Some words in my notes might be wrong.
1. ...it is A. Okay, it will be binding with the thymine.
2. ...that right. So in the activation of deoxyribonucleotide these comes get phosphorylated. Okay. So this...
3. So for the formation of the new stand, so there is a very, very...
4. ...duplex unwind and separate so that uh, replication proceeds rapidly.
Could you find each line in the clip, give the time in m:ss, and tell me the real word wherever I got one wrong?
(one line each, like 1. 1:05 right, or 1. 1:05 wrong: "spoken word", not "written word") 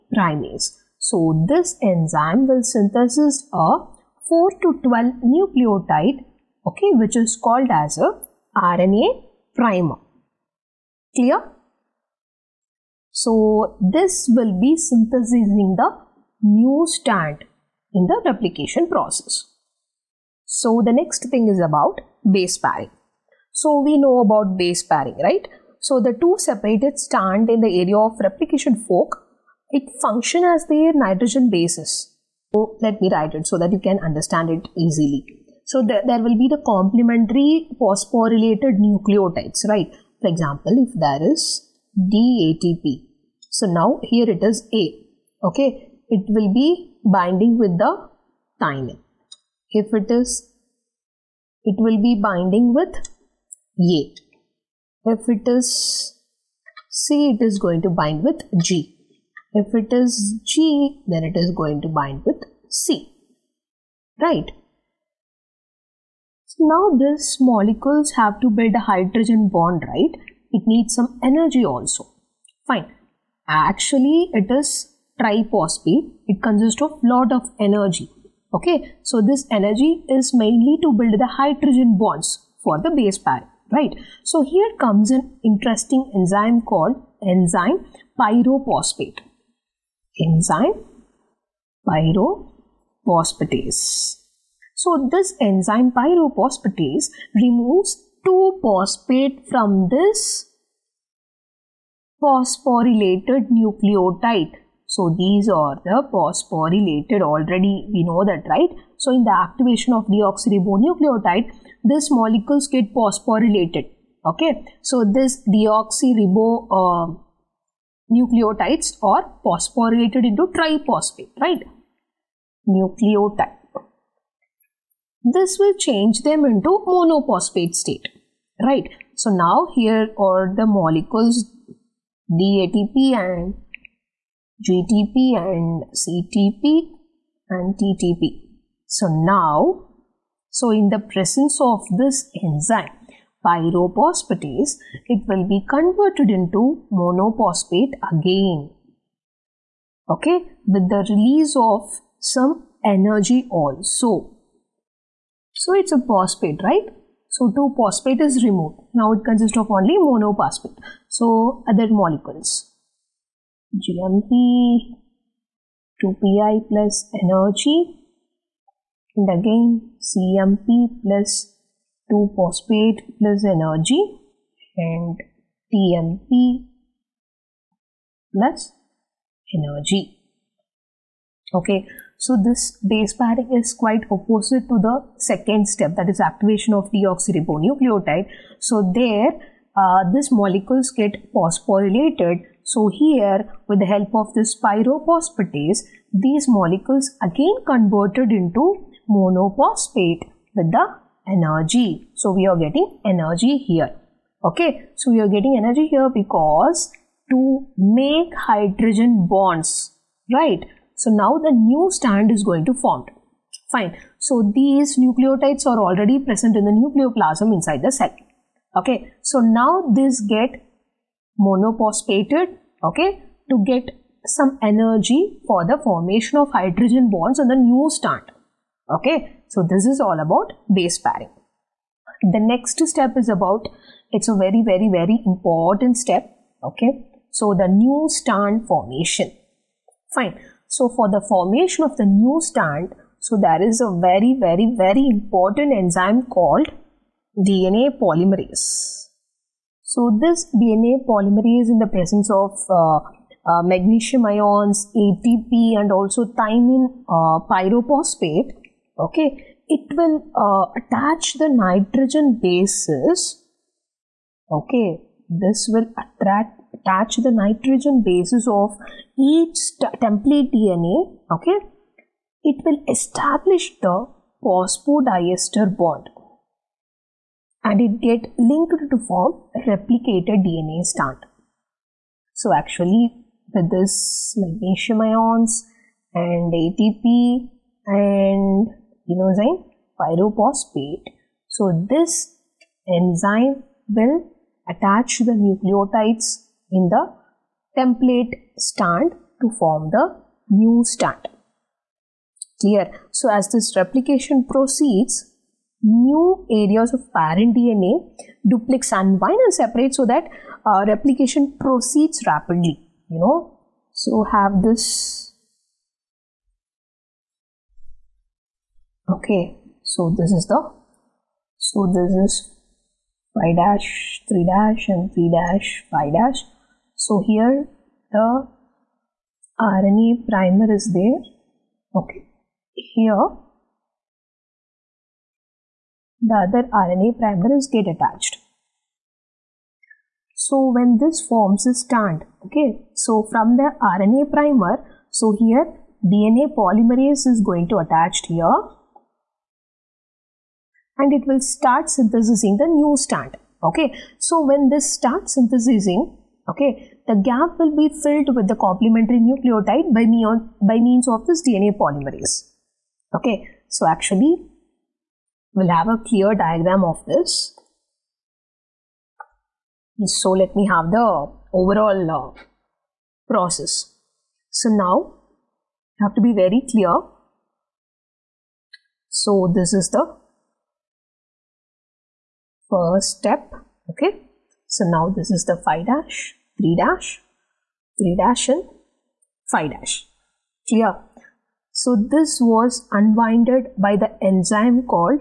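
1. 0:44 right
2. 1:48 wrong: "molecules", not "comes"
3. 4:00 wrong: "strand", not "stand"
4. 5:08 right.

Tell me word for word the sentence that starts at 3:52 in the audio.
The next step is about, it's a very, very, very important step.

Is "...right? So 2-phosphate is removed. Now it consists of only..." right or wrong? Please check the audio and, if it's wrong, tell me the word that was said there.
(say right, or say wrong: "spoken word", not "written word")
right.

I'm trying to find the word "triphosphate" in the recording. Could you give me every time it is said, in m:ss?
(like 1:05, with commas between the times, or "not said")
1:15, 2:00.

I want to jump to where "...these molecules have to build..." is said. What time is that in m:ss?
1:06.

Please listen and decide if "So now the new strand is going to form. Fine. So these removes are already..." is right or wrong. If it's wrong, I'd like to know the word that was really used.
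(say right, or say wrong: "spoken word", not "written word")
wrong: "nucleotides", not "removes".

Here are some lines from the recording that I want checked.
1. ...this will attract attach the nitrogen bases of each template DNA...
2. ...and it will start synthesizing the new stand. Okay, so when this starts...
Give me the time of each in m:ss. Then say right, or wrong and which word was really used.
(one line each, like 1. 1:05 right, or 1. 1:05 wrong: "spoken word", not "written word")
1. 4:25 right
2. 5:50 right.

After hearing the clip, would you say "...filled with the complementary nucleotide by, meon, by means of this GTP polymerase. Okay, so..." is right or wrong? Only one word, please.
wrong.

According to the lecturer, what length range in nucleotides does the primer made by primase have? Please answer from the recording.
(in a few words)
4 to 12.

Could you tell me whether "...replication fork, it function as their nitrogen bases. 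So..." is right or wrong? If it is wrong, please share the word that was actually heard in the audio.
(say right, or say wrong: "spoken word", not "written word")
right.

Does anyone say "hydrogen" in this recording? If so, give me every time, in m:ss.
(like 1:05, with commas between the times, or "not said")
1:08, 1:21, 3:28, 3:46.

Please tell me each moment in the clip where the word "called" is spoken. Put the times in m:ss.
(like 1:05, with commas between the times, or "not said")
0:07, 1:26, 4:06.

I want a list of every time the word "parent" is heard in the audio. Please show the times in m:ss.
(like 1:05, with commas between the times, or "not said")
5:07.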